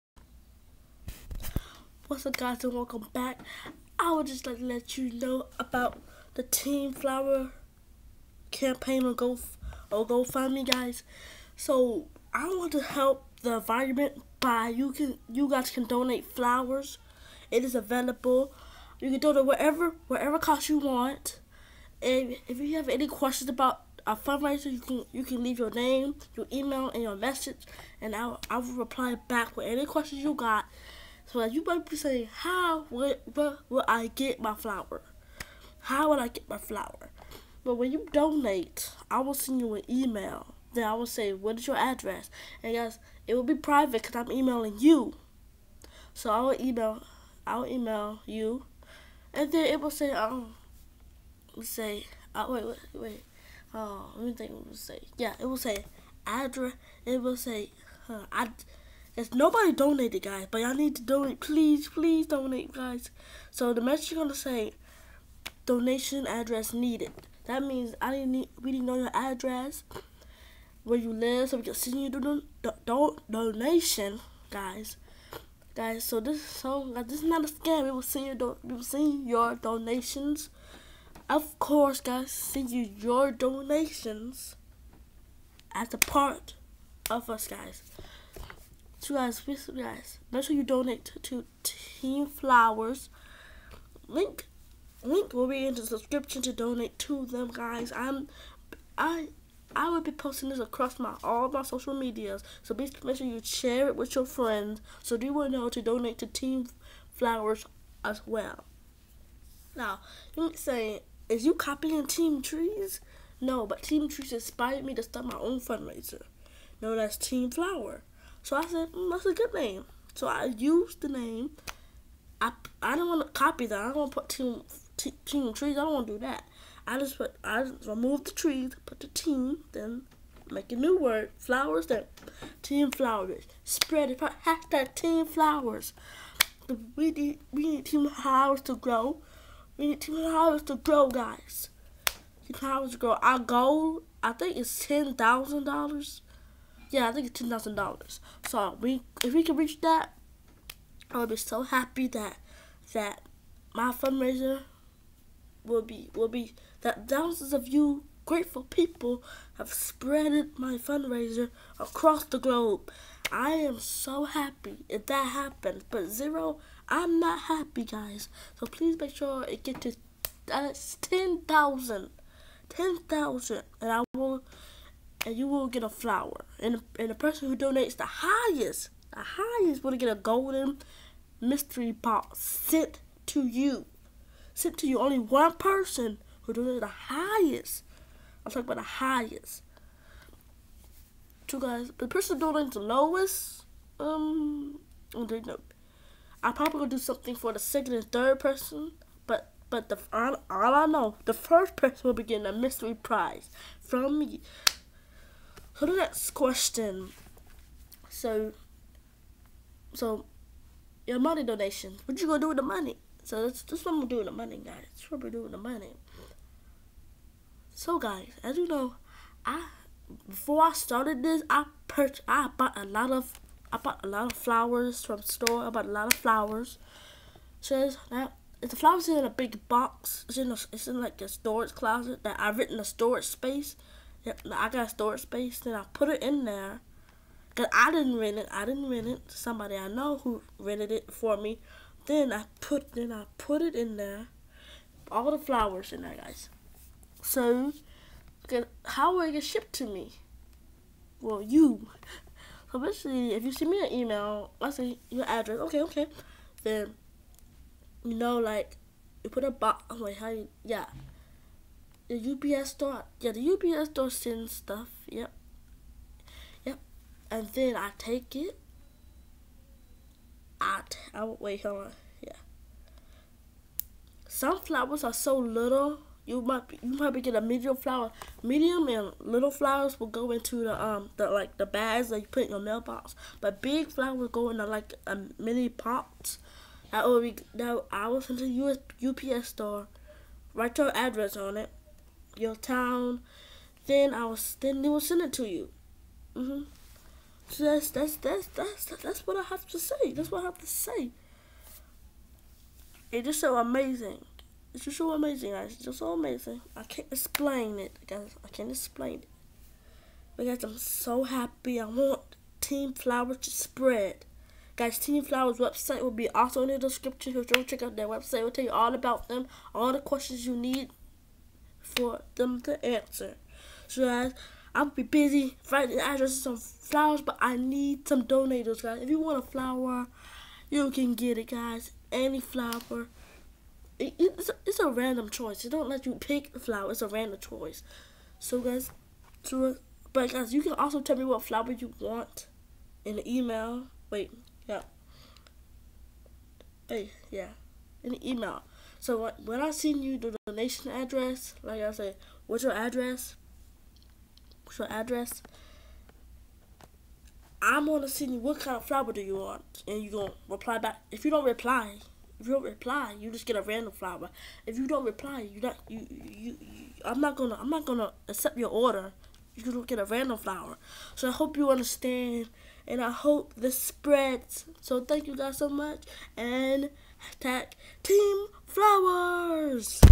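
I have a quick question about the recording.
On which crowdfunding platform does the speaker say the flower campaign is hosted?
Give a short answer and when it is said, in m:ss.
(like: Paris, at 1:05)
GoFundMe, at 0:10.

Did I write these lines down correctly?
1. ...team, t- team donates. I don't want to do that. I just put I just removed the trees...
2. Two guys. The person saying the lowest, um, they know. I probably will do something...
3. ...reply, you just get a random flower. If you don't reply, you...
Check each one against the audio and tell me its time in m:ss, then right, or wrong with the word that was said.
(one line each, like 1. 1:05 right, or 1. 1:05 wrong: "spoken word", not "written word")
1. 2:04 wrong: "trees", not "donates"
2. 3:11 wrong: "donating", not "saying"
3. 6:02 right.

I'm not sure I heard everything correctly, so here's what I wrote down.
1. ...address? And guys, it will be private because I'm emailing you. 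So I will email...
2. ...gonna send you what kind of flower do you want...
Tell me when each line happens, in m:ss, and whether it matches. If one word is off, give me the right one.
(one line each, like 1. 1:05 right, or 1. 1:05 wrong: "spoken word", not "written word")
1. 0:41 right
2. 5:57 right.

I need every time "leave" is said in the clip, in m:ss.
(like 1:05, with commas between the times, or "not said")
0:25.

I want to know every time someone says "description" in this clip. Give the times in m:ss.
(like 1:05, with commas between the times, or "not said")
1:35, 5:16.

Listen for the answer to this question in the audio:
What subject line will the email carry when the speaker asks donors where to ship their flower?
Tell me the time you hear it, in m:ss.
1:05.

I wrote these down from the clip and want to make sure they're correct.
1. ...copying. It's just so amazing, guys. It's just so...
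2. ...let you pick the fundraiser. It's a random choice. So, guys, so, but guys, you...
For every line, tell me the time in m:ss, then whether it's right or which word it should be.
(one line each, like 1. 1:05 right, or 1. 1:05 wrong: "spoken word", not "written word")
1. 5:03 wrong: "amazing", not "copying"
2. 5:35 wrong: "flower", not "fundraiser".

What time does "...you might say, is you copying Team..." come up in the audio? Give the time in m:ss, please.
1:50.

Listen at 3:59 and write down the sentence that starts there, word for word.
Somebody I know who rented it for me.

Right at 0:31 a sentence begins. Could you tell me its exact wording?
So you might be saying, how will, will I get my flower?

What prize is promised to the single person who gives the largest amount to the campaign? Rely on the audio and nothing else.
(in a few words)
Golden mystery box.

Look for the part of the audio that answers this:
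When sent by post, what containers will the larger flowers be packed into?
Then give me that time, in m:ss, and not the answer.
4:45.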